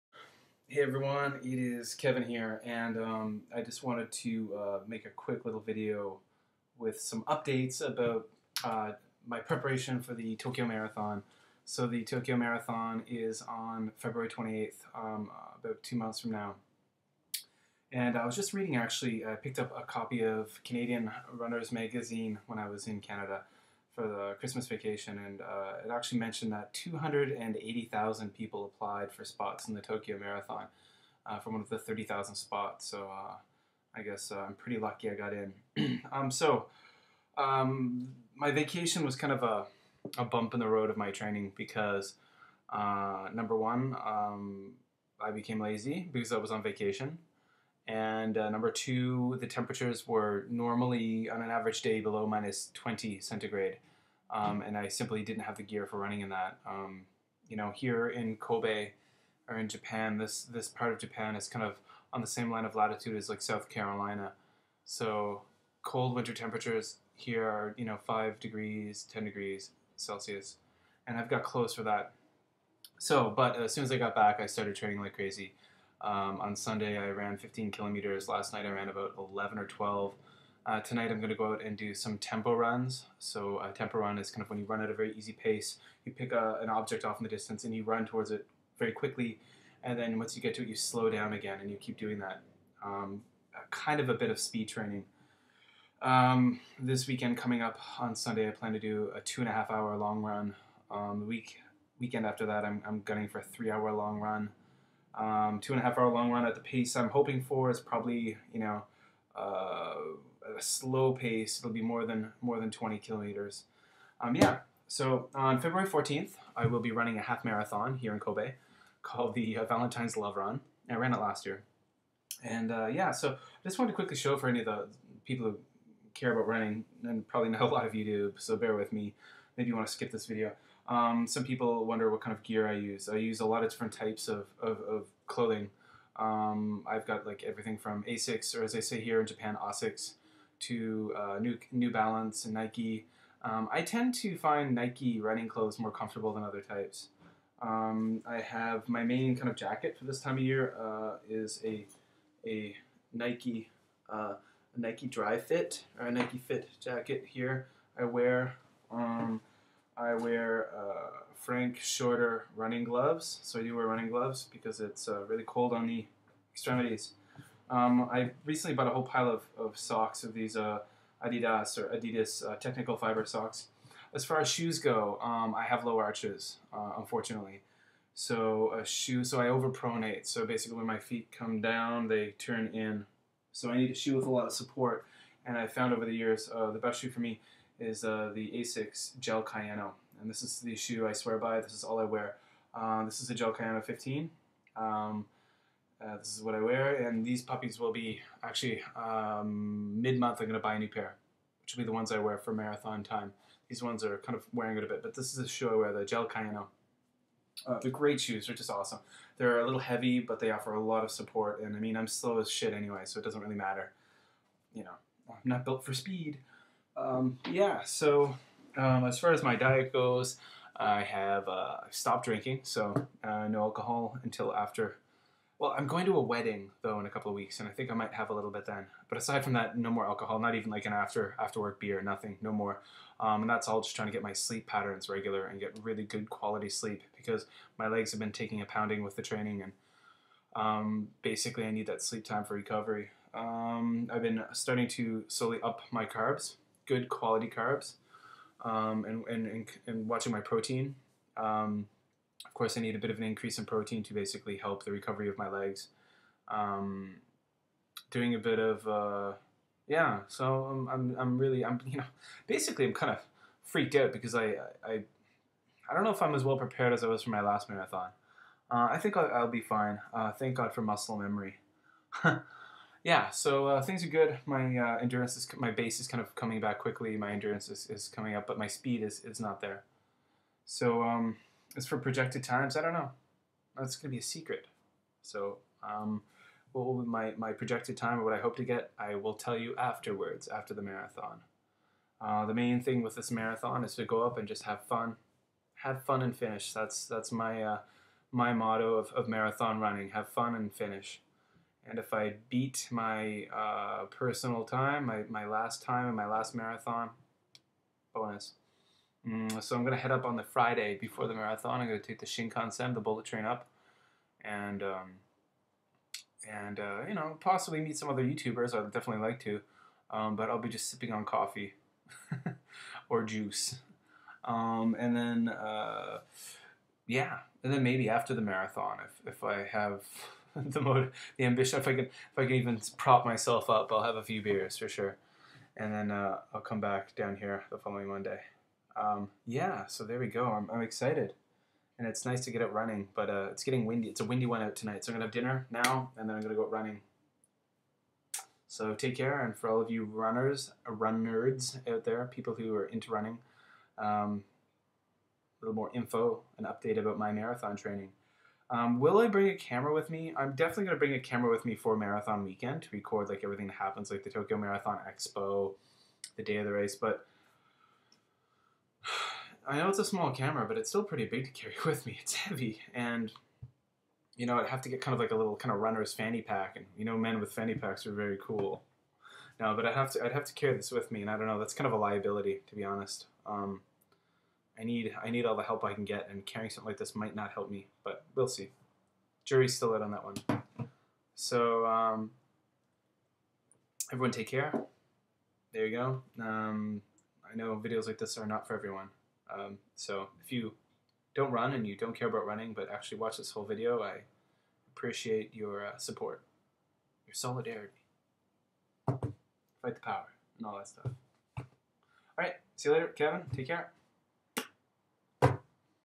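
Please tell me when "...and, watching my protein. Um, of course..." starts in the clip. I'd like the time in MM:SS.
04:09.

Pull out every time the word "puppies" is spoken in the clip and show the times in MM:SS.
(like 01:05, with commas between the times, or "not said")
03:17.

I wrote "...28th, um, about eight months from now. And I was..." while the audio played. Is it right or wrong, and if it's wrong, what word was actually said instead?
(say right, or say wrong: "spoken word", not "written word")
wrong: "two", not "eight".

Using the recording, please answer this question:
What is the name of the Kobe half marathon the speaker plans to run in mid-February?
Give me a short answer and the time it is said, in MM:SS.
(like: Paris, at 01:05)
Valentine's Love Run, at 01:59.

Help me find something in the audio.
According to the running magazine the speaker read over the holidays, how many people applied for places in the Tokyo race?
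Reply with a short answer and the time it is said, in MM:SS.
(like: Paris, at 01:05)
280,000, at 00:26.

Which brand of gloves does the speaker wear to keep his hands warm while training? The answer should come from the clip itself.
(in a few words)
Frank Shorter.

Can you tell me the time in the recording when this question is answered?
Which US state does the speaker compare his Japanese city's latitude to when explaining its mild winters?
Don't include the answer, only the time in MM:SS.
01:03.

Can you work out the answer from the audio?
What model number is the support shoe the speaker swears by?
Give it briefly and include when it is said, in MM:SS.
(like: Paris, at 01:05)
15, at 03:13.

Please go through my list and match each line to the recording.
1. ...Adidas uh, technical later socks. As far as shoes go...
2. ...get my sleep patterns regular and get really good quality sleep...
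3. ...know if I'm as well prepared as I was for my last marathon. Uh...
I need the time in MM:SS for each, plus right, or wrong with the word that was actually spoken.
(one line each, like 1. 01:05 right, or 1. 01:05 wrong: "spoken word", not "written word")
1. 02:51 wrong: "fiber", not "later"
2. 03:54 right
3. 04:26 right.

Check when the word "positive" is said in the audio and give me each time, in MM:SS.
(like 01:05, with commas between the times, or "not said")
not said.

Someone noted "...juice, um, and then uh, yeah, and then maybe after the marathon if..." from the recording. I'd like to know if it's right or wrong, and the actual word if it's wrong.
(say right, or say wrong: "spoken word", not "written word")
right.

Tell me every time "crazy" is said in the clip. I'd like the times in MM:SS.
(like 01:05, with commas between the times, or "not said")
01:15.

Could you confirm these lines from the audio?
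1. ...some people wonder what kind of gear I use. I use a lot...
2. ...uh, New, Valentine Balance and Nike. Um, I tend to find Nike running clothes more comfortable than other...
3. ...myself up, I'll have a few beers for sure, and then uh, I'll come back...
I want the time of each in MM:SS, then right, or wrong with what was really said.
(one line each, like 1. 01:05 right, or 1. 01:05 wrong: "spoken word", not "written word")
1. 02:11 right
2. 02:21 wrong: "New", not "Valentine"
3. 05:33 right.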